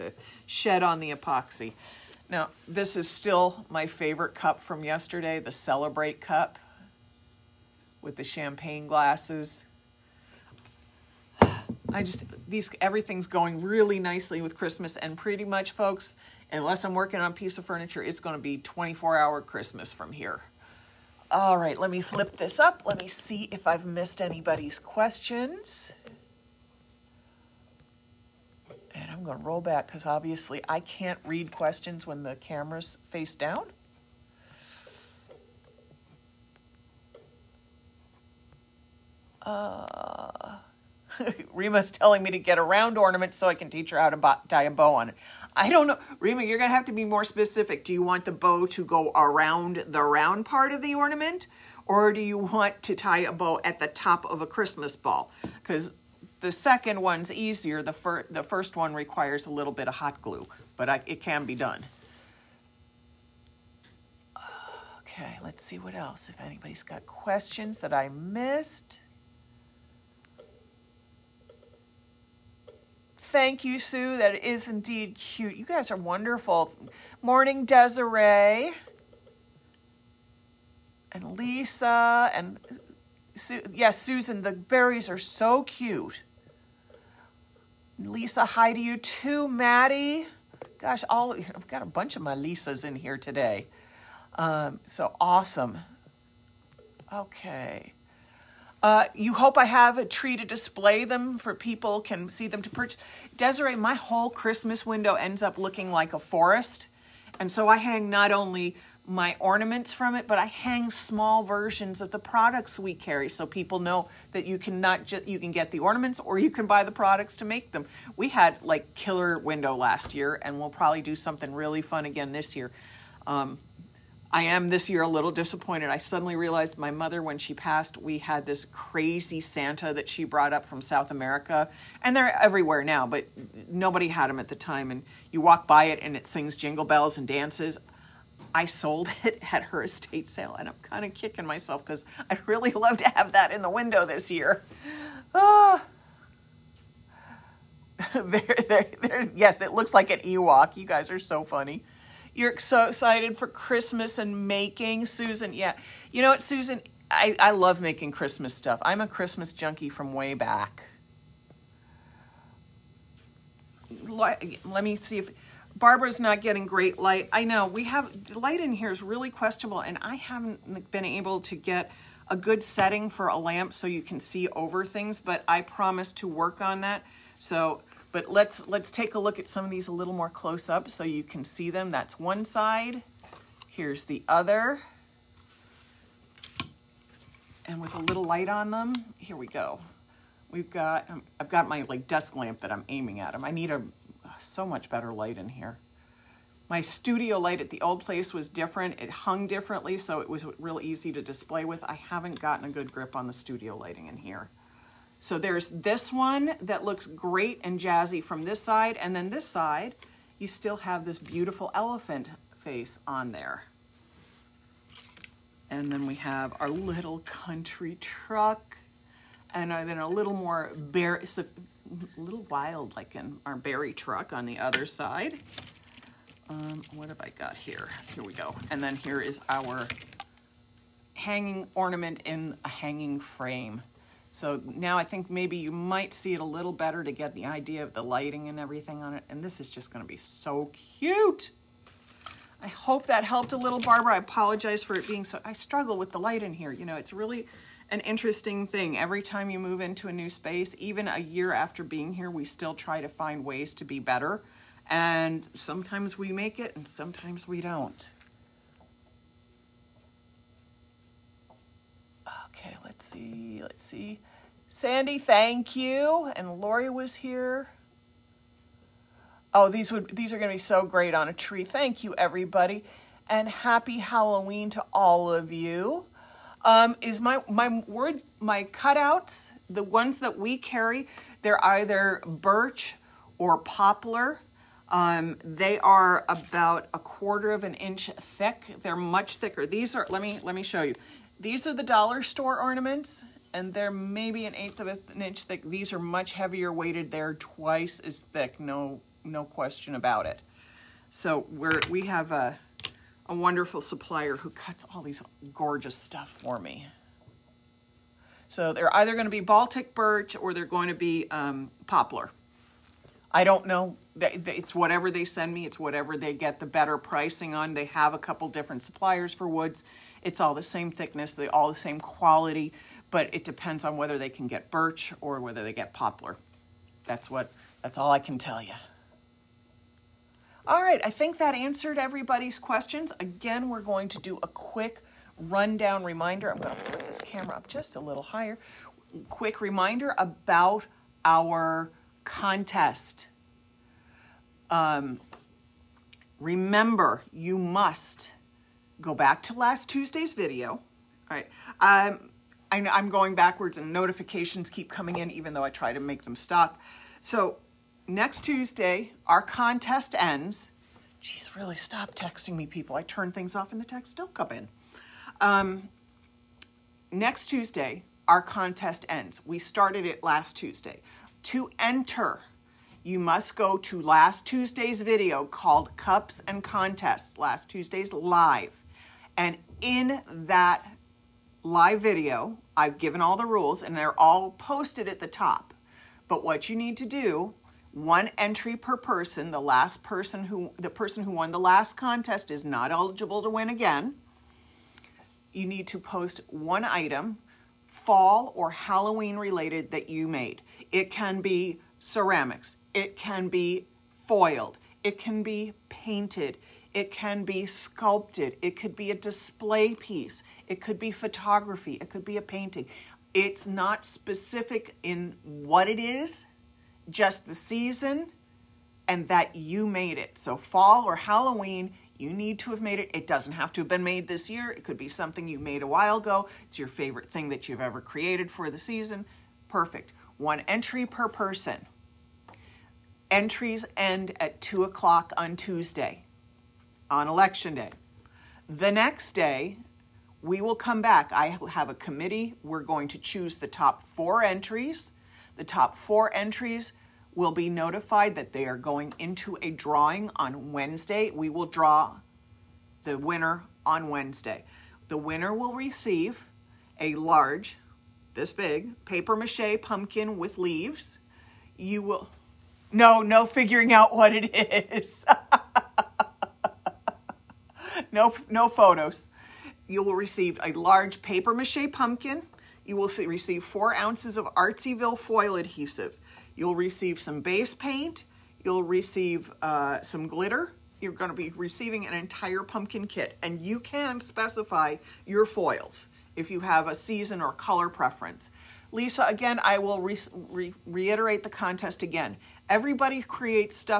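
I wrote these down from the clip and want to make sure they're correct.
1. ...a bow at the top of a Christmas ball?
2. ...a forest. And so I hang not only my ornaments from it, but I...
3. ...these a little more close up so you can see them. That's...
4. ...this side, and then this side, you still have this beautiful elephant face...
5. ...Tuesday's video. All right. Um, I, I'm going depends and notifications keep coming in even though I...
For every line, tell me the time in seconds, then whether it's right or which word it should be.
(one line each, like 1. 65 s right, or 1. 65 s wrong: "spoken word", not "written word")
1. 53 s right
2. 106 s right
3. 179 s right
4. 208 s right
5. 349 s wrong: "backwards", not "depends".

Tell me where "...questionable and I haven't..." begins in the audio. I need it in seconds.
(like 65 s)
169 s.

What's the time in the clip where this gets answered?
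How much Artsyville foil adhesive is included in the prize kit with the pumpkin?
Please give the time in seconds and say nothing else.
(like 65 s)
473 s.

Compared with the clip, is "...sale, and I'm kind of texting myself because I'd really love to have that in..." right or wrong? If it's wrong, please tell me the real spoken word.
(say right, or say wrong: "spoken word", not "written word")
wrong: "kicking", not "texting".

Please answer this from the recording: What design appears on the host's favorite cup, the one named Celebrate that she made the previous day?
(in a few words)
Champagne glasses.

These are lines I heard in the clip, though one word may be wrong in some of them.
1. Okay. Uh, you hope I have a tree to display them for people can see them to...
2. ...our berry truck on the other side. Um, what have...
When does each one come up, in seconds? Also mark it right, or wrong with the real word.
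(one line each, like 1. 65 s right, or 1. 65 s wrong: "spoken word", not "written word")
1. 97 s right
2. 223 s right.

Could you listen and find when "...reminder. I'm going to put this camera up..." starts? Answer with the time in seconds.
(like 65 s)
336 s.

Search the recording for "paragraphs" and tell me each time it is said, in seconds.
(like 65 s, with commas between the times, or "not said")
not said.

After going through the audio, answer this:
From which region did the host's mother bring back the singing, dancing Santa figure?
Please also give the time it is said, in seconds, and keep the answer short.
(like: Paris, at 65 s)
South America, at 130 s.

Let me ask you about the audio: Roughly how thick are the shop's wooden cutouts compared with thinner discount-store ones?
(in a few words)
A quarter of an inch.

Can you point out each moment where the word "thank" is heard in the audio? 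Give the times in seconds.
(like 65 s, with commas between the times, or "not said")
73 s, 265 s, 271 s.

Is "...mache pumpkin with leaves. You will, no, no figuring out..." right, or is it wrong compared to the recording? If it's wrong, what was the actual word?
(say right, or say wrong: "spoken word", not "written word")
right.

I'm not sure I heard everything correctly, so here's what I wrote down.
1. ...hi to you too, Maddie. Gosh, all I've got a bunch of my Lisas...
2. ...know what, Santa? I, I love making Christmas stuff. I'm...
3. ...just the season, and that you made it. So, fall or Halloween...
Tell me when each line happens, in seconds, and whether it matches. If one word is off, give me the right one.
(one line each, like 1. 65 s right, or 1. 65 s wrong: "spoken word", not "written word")
1. 88 s right
2. 156 s wrong: "Susan", not "Santa"
3. 417 s right.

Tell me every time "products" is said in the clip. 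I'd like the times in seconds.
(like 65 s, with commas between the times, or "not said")
112 s, 116 s.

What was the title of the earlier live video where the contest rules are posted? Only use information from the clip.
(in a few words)
Cups and Contests.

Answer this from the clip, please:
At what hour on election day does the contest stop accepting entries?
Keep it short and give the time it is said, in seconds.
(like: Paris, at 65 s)
2 o'clock, at 434 s.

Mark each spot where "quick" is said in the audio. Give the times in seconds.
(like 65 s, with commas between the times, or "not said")
334 s, 339 s.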